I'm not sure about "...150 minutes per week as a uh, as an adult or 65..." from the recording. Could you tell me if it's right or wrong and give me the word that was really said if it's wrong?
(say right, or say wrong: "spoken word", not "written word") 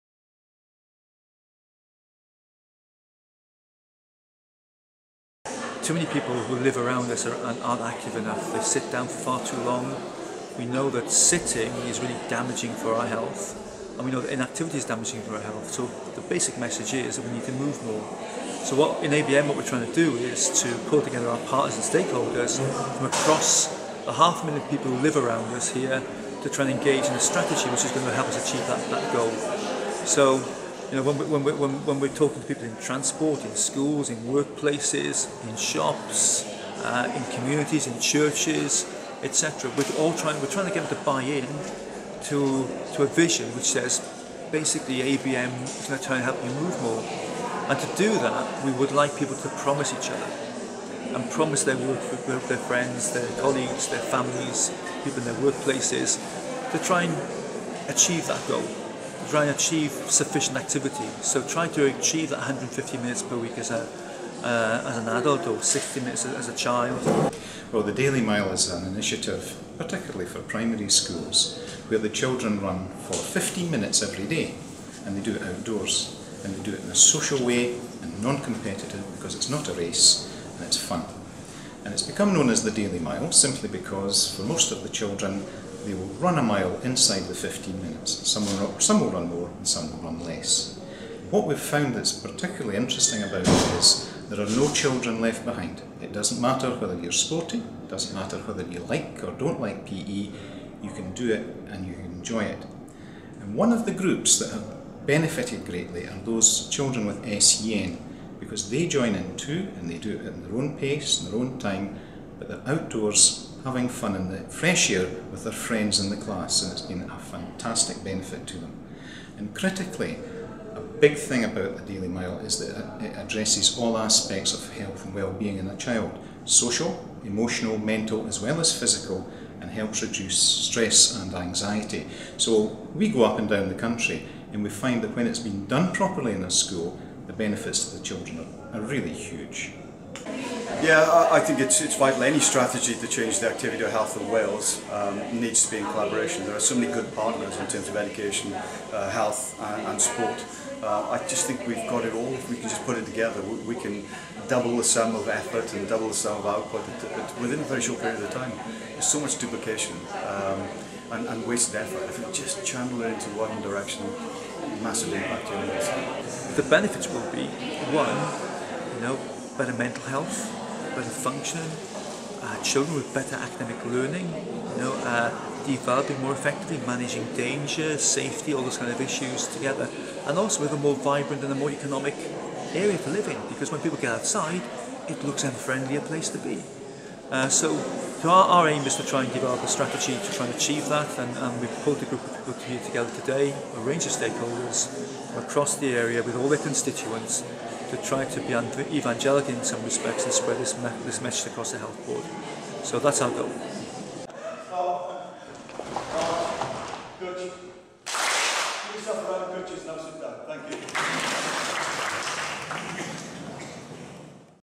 wrong: "60", not "65".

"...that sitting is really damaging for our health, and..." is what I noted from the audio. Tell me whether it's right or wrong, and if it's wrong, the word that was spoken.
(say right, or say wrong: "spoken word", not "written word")
right.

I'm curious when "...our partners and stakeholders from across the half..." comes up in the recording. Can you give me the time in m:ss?
0:21.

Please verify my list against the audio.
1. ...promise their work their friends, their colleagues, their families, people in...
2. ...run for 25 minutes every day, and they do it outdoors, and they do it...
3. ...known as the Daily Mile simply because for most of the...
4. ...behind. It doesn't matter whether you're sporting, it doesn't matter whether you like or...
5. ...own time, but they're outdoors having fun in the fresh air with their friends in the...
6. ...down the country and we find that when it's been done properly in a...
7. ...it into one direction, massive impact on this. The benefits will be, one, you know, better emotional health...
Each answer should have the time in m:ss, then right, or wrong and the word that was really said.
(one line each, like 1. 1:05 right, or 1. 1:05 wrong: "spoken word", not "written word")
1. 0:51 right
2. 1:12 wrong: "15", not "25"
3. 1:22 right
4. 1:35 right
5. 1:51 right
6. 2:13 right
7. 2:43 wrong: "mental", not "emotional".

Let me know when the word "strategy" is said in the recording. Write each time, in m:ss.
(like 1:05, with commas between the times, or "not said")
0:27, 2:22, 3:09.